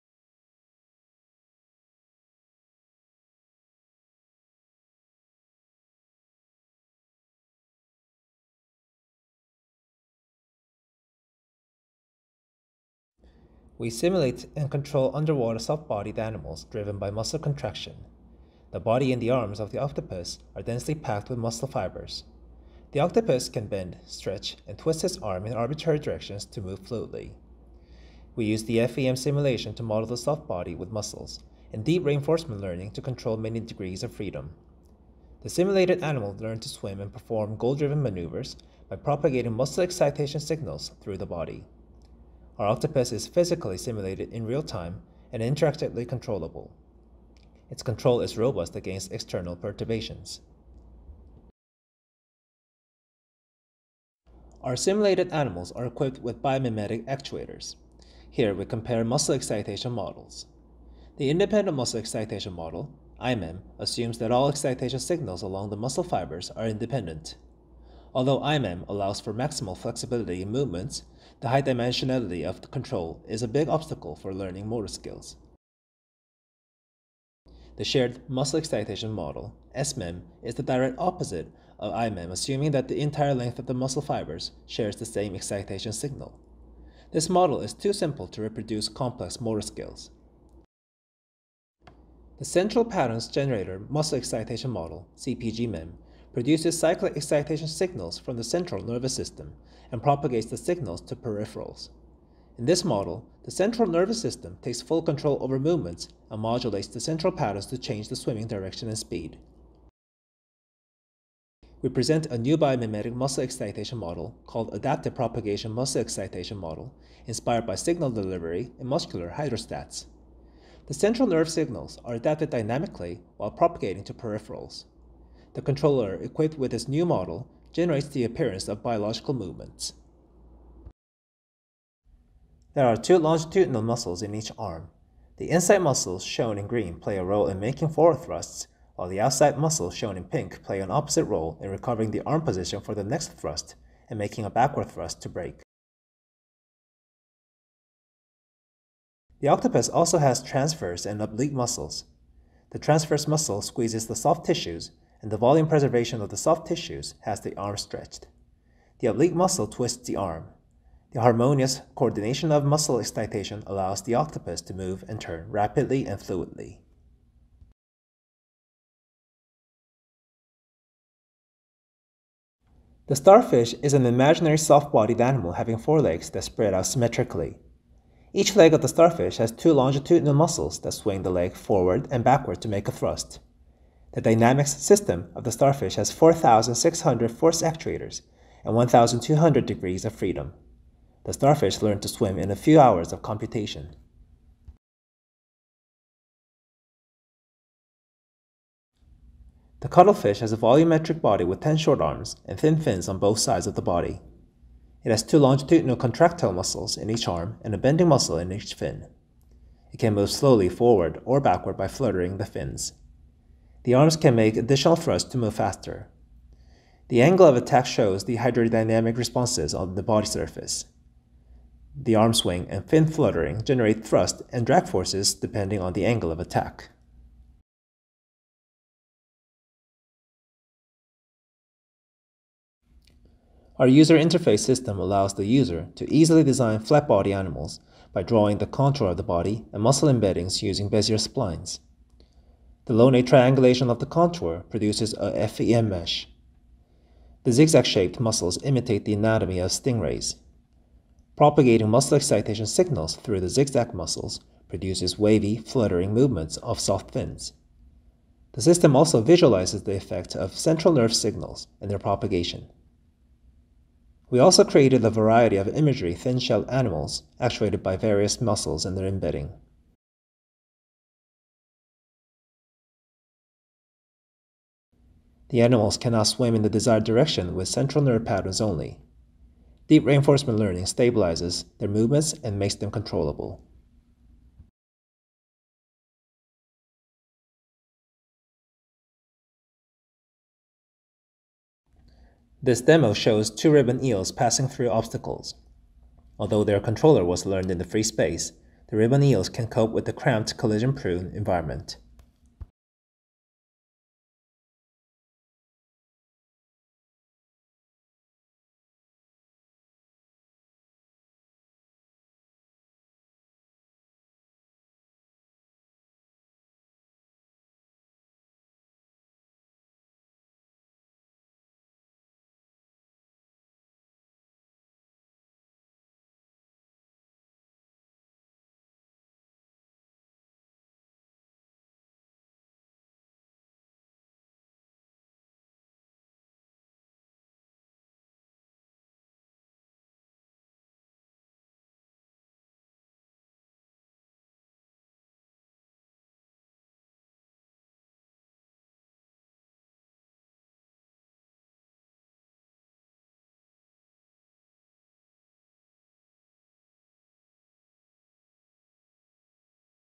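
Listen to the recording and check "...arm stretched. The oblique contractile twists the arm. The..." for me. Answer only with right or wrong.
wrong.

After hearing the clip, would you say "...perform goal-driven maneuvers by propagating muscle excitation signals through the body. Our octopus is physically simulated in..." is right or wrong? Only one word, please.
right.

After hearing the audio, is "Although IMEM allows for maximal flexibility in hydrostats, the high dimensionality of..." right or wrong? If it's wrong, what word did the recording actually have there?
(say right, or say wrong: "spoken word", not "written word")
wrong: "movements", not "hydrostats".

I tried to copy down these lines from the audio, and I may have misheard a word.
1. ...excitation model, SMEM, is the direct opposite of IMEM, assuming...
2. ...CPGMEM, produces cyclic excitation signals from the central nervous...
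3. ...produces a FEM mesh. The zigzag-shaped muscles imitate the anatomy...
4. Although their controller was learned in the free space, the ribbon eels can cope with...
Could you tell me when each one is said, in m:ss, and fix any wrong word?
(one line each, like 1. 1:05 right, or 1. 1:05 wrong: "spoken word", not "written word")
1. 1:18 right
2. 1:35 right
3. 4:04 right
4. 4:56 right.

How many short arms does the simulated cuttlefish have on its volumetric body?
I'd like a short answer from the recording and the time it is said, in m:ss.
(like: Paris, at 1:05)
10, at 3:21.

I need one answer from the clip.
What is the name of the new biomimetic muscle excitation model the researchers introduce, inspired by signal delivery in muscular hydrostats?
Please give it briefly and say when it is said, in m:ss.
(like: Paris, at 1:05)
Adaptive Propagation Muscle Excitation Model, at 1:54.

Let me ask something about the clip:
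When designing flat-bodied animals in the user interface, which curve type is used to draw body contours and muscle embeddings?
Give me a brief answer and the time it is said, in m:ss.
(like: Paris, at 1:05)
Bezier splines, at 4:00.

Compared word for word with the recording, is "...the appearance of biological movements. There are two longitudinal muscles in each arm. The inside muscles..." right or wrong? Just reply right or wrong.
right.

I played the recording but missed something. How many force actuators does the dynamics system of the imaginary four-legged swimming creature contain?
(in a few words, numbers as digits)
4,600.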